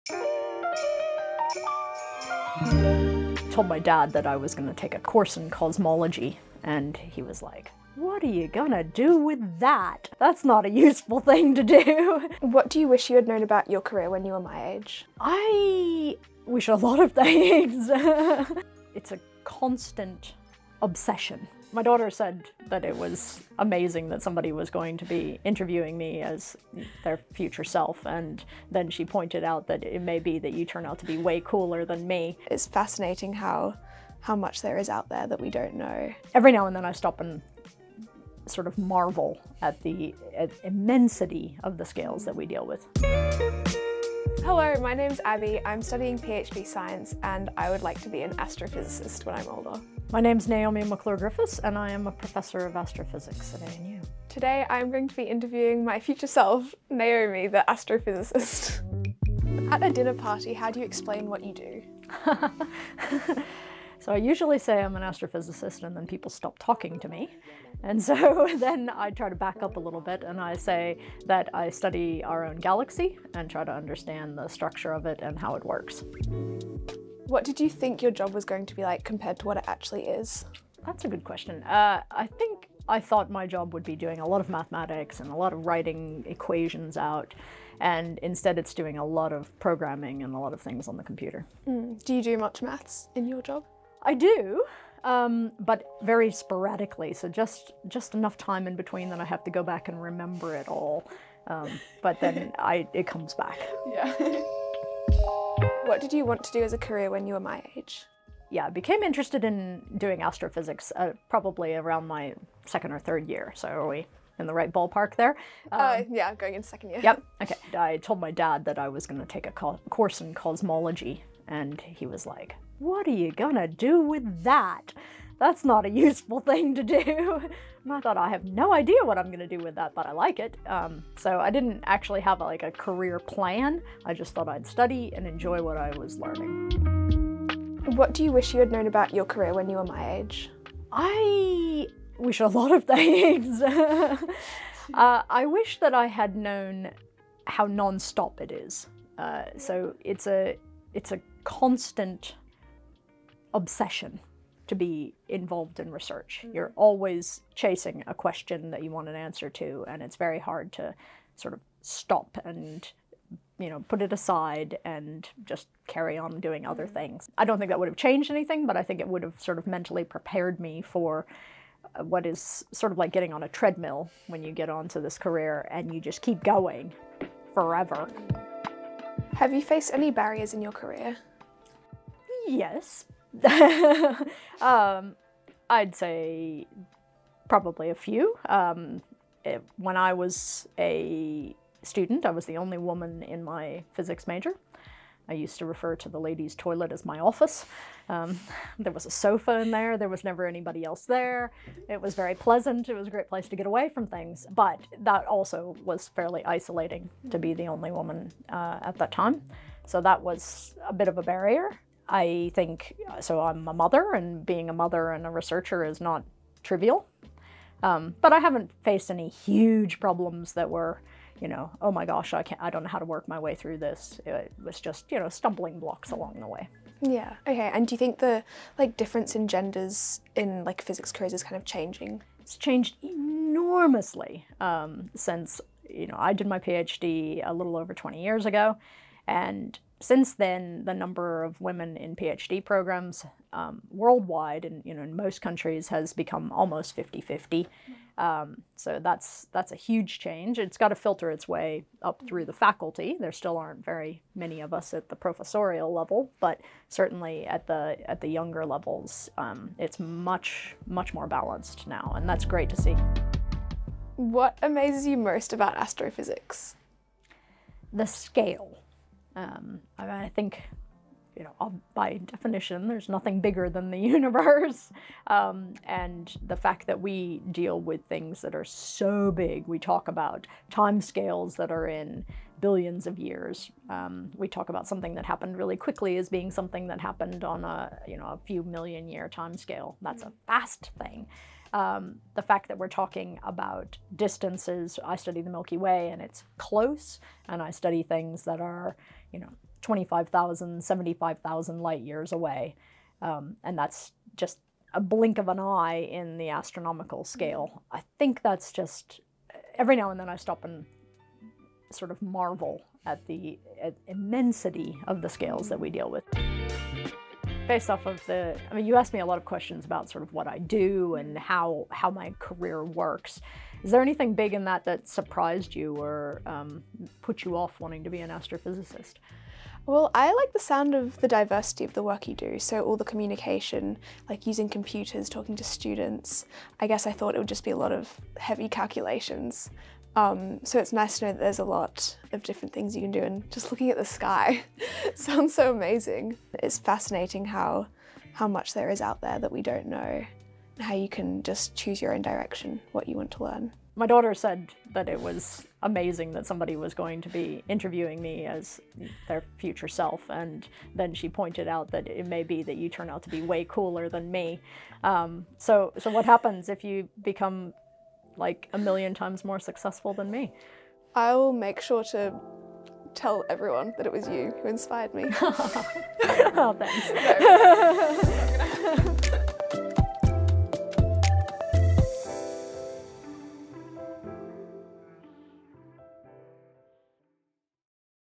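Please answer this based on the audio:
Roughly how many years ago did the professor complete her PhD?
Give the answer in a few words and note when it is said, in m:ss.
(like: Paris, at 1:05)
A little over 20 years, at 3:57.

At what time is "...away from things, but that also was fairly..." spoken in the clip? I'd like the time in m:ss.
3:23.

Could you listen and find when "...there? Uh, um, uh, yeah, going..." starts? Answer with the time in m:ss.
1:55.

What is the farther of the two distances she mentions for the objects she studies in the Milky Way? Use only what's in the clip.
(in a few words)
75,000 light years.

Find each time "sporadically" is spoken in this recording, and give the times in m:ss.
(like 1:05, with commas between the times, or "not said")
1:36.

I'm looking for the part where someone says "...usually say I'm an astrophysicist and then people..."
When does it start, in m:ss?
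1:04.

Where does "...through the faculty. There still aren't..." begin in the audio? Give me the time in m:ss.
4:12.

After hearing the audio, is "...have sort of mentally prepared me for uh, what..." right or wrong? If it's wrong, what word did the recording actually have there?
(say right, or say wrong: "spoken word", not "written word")
right.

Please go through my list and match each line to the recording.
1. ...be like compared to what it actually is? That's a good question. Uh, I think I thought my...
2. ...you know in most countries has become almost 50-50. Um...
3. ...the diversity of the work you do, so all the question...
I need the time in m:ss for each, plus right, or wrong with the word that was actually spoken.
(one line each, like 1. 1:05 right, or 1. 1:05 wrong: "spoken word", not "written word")
1. 1:18 right
2. 4:04 right
3. 5:31 wrong: "communication", not "question".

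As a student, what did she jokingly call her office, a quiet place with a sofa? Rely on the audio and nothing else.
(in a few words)
The ladies' toilet.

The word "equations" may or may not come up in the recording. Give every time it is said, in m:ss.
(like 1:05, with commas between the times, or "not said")
1:26.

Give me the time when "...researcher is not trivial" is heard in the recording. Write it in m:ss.
3:35.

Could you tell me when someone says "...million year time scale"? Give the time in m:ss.
4:48.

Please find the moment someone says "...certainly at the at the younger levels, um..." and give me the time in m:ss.
4:16.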